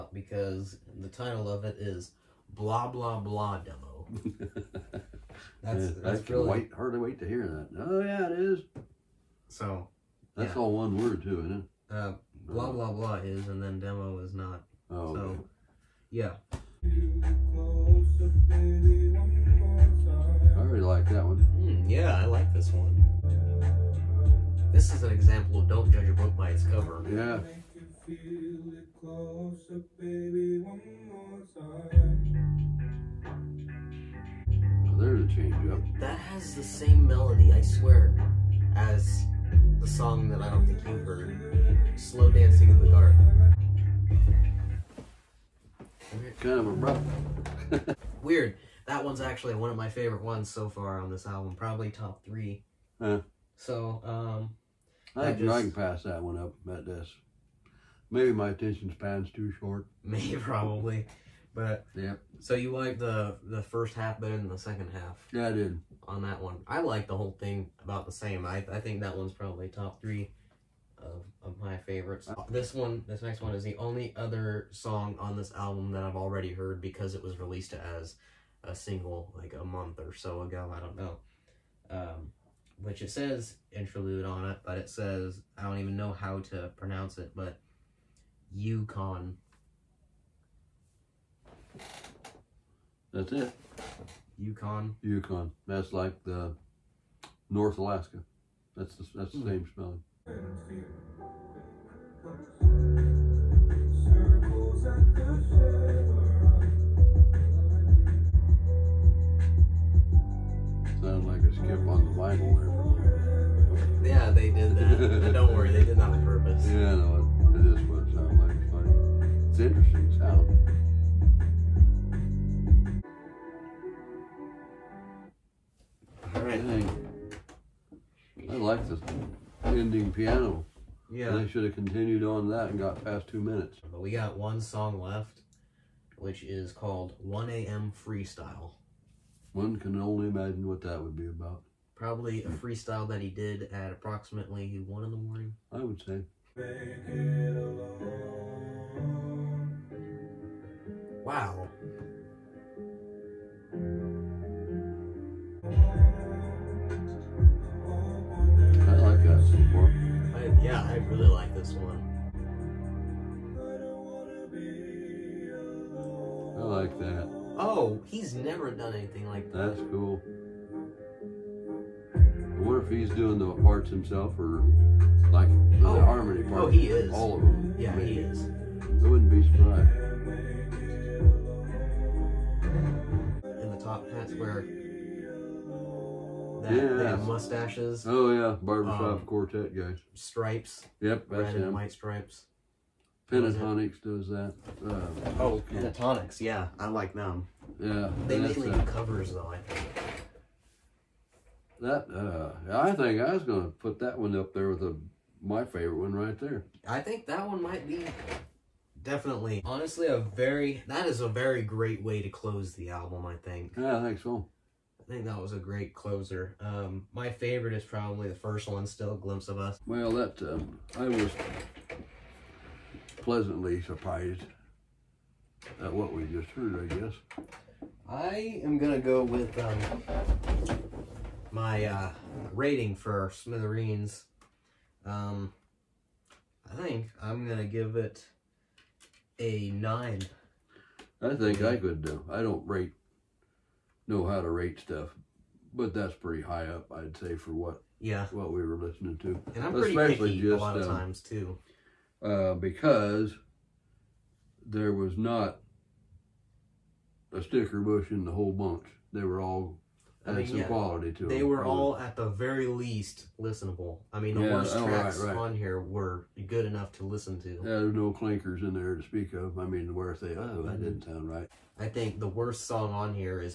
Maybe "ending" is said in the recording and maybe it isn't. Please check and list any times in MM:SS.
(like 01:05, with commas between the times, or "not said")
02:09.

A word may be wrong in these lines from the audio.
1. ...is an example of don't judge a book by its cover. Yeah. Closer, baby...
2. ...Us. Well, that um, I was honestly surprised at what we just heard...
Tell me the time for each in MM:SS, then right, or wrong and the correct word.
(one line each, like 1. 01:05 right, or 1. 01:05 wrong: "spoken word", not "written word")
1. 00:24 right
2. 03:39 wrong: "pleasantly", not "honestly".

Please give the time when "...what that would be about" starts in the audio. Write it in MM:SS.
02:20.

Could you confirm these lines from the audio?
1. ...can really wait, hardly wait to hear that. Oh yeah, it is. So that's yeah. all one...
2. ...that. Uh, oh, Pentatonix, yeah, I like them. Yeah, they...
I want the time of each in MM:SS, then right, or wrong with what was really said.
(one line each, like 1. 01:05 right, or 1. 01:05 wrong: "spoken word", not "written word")
1. 00:06 right
2. 03:14 right.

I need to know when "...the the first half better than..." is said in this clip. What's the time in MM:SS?
01:02.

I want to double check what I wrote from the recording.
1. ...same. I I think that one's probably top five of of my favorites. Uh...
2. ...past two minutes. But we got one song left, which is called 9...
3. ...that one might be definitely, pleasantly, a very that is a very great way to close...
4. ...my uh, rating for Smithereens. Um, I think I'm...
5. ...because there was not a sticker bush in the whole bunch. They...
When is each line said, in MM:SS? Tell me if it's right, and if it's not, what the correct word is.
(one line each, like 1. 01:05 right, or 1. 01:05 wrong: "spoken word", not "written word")
1. 01:08 wrong: "three", not "five"
2. 02:13 wrong: "1", not "9"
3. 03:27 wrong: "honestly", not "pleasantly"
4. 03:51 right
5. 04:12 right.